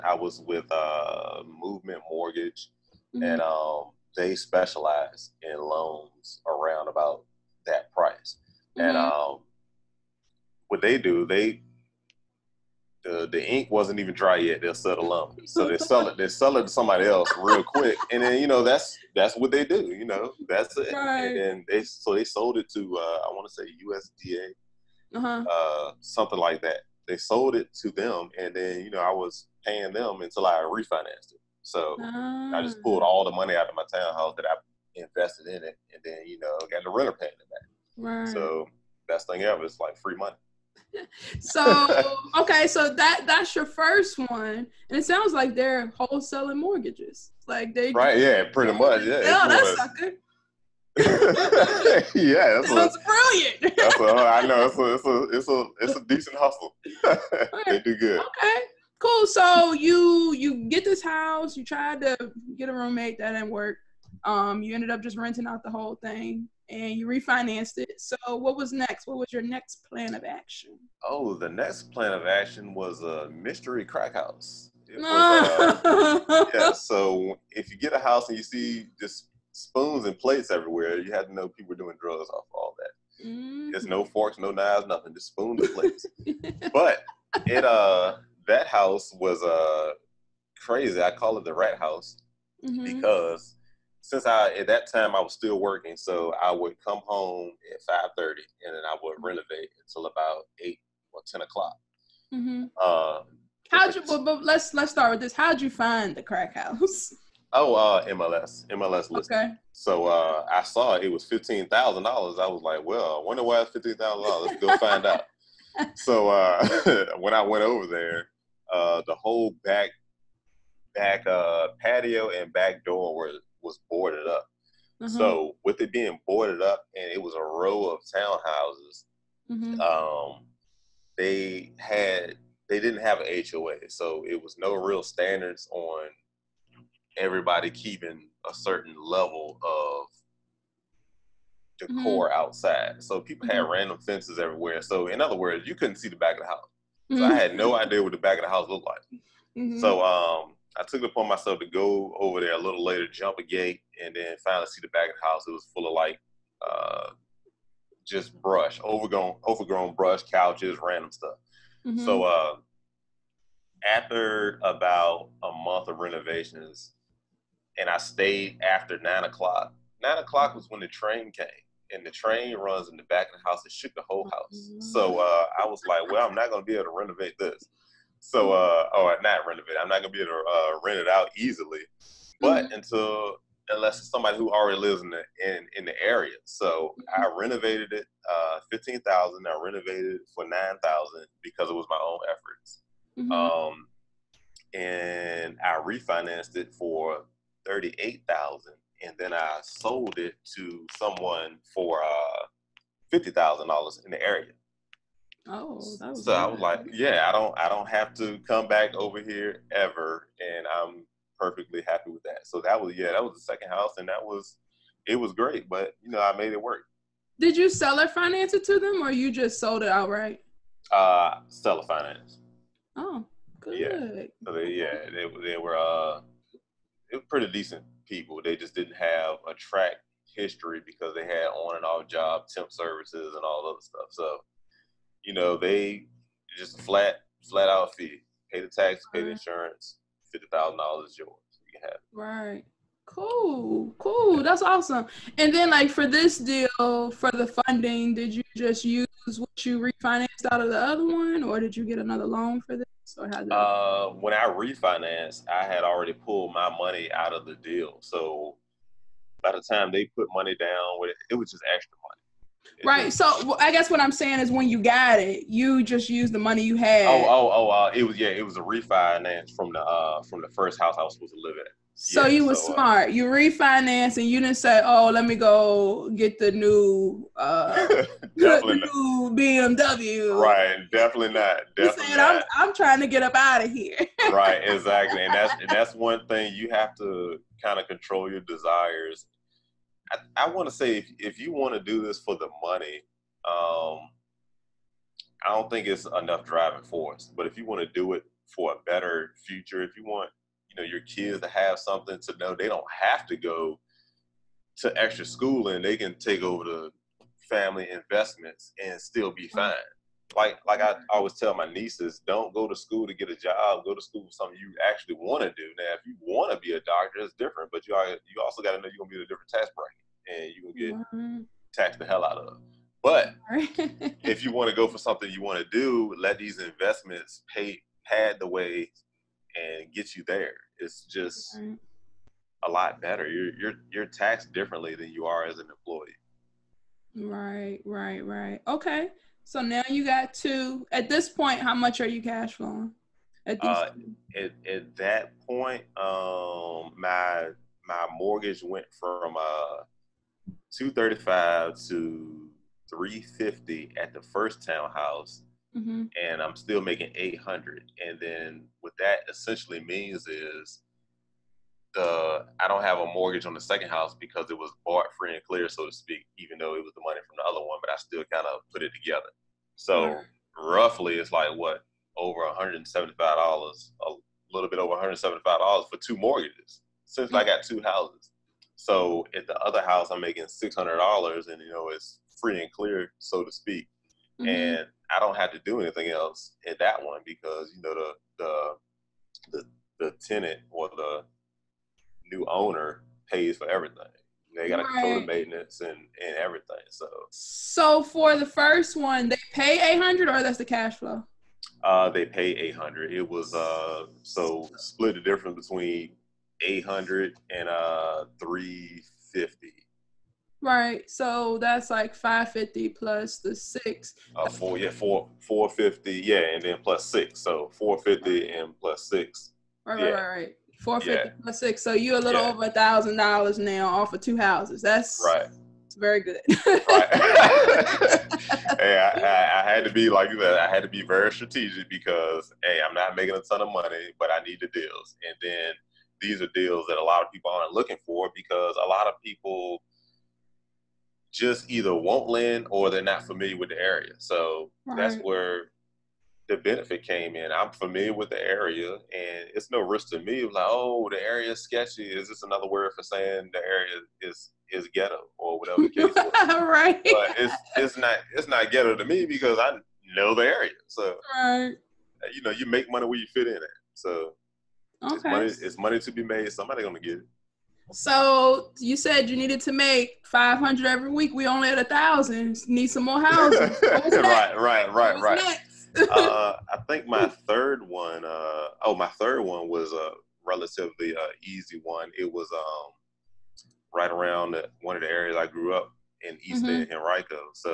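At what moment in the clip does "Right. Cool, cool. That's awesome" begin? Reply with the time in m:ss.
4:02.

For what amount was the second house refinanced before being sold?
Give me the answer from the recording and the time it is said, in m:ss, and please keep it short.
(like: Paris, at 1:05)
$38,000, at 3:17.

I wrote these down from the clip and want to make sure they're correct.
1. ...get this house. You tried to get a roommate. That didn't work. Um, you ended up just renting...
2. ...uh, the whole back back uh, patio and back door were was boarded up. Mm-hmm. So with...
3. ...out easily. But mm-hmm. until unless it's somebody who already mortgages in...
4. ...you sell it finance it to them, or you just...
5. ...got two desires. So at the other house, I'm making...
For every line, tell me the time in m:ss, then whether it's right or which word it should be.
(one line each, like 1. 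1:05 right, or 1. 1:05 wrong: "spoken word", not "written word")
1. 1:00 right
2. 1:58 right
3. 3:01 wrong: "lives", not "mortgages"
4. 3:37 right
5. 6:17 wrong: "houses", not "desires".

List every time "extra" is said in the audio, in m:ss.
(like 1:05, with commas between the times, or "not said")
4:21, 5:04.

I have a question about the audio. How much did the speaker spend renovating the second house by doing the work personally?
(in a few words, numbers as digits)
$9,000.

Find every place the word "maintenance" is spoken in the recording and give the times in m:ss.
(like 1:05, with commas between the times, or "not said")
6:35.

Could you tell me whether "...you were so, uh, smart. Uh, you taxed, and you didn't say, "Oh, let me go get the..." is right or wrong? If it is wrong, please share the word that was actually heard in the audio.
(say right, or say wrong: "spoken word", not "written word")
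wrong: "refinanced", not "taxed".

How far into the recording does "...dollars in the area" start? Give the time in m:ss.
3:23.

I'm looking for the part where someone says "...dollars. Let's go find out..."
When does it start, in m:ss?
1:54.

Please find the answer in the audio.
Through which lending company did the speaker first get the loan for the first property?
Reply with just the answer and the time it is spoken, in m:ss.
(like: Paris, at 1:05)
Movement Mortgage, at 0:01.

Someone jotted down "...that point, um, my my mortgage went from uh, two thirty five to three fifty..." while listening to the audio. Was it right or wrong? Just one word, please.
right.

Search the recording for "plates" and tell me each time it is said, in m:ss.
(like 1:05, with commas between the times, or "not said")
1:20, 1:25.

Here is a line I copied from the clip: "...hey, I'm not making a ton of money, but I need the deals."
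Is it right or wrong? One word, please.
right.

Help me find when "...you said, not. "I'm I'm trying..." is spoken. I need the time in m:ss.
4:42.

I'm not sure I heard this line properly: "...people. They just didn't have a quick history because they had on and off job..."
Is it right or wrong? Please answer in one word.
wrong.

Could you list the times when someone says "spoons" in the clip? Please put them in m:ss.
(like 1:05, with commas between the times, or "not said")
1:19, 1:25.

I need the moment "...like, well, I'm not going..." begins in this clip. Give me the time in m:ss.
2:55.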